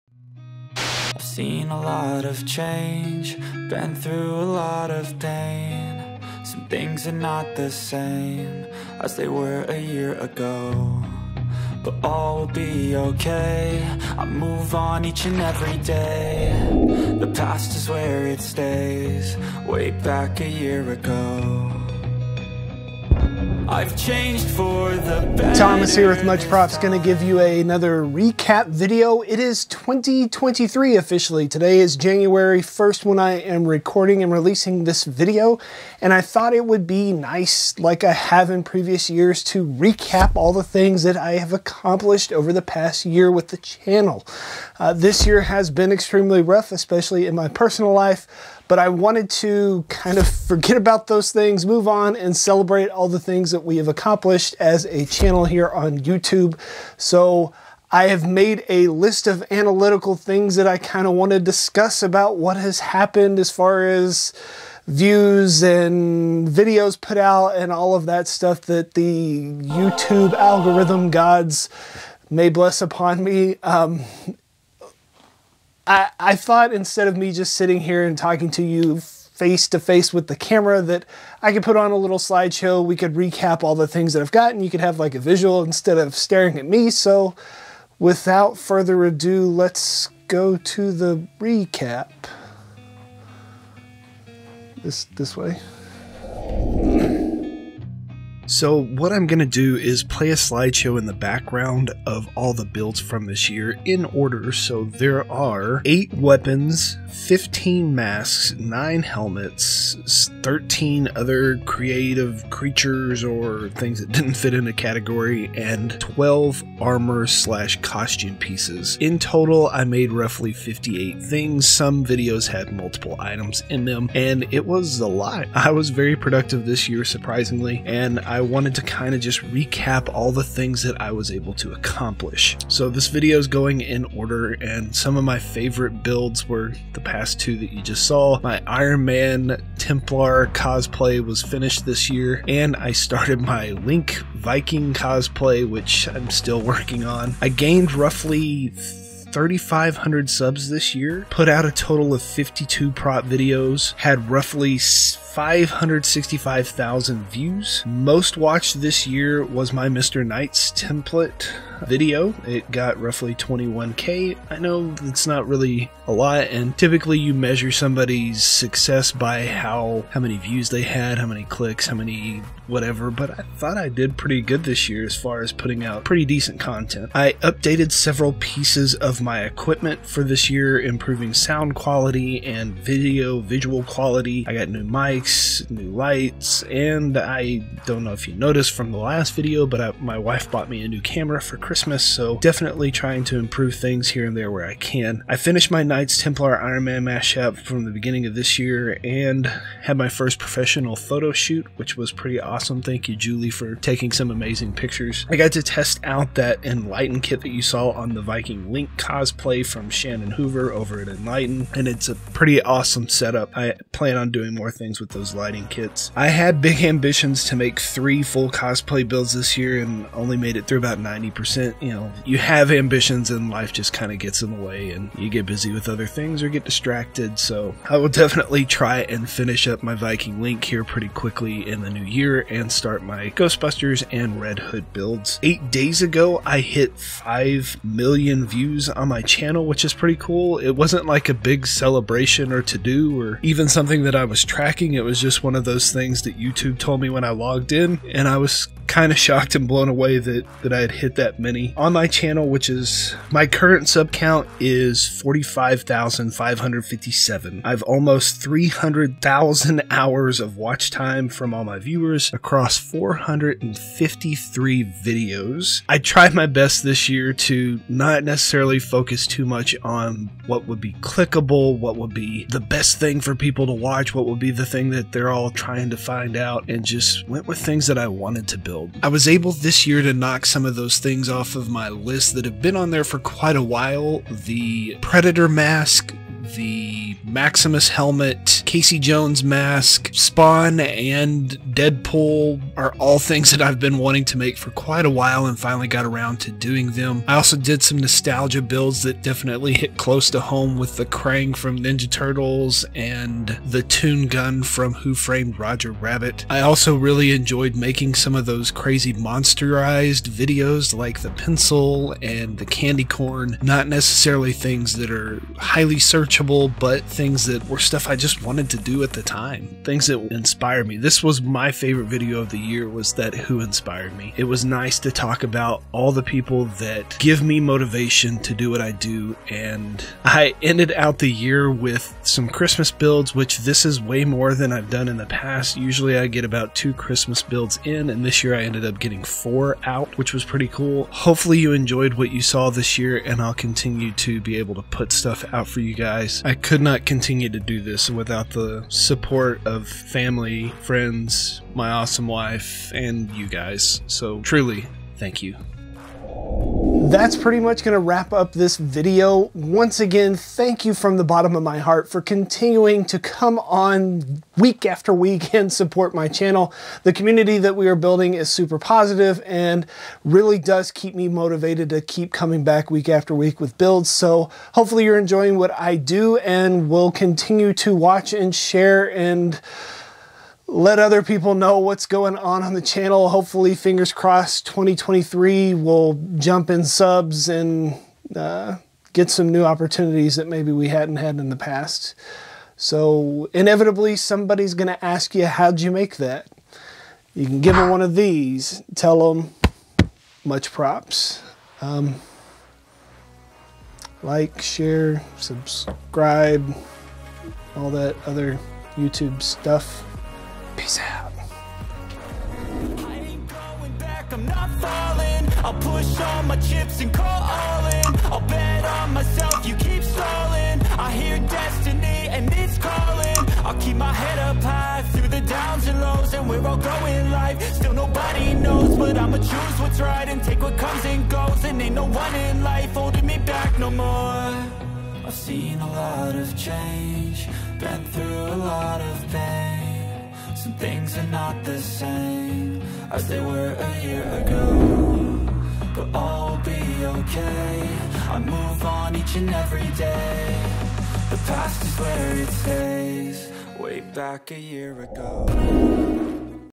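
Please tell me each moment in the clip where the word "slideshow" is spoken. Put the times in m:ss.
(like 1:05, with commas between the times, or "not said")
1:22, 1:40.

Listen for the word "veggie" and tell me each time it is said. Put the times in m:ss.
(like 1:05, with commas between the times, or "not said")
not said.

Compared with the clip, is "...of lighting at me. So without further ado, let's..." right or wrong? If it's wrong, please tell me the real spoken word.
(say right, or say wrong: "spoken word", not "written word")
wrong: "staring", not "lighting".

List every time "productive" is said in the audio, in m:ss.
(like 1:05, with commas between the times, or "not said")
2:06.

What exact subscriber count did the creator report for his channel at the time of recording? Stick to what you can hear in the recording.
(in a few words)
45,557.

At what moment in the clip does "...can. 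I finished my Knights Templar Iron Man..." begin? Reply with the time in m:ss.
3:14.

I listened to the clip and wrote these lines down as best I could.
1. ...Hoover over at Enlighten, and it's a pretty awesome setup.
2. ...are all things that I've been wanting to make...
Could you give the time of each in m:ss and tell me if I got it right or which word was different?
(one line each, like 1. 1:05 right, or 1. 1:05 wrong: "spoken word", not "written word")
1. 3:30 right
2. 4:52 right.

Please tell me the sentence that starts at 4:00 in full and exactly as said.
It wasn't like a big celebration or to do or even something that I was tracking.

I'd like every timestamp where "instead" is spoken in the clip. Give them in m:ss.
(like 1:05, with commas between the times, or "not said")
1:16, 1:25.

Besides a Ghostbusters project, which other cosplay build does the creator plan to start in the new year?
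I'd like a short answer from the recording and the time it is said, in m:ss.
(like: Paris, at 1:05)
Red Hood, at 3:54.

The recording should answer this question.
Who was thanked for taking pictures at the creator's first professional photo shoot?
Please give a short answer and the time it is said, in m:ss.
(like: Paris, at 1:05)
Julie, at 3:23.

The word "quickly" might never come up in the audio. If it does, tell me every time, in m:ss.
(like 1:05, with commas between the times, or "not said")
3:51.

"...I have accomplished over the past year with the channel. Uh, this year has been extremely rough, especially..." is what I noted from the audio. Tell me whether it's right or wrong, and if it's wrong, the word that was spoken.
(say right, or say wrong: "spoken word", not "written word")
right.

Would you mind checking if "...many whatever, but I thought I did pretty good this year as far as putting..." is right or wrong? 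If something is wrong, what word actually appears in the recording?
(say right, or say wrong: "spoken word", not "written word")
right.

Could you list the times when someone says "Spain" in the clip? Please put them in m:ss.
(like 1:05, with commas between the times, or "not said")
not said.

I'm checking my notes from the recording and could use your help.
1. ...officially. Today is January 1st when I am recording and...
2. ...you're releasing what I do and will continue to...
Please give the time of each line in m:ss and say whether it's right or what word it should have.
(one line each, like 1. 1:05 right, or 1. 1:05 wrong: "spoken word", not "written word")
1. 0:30 right
2. 6:15 wrong: "enjoying", not "releasing".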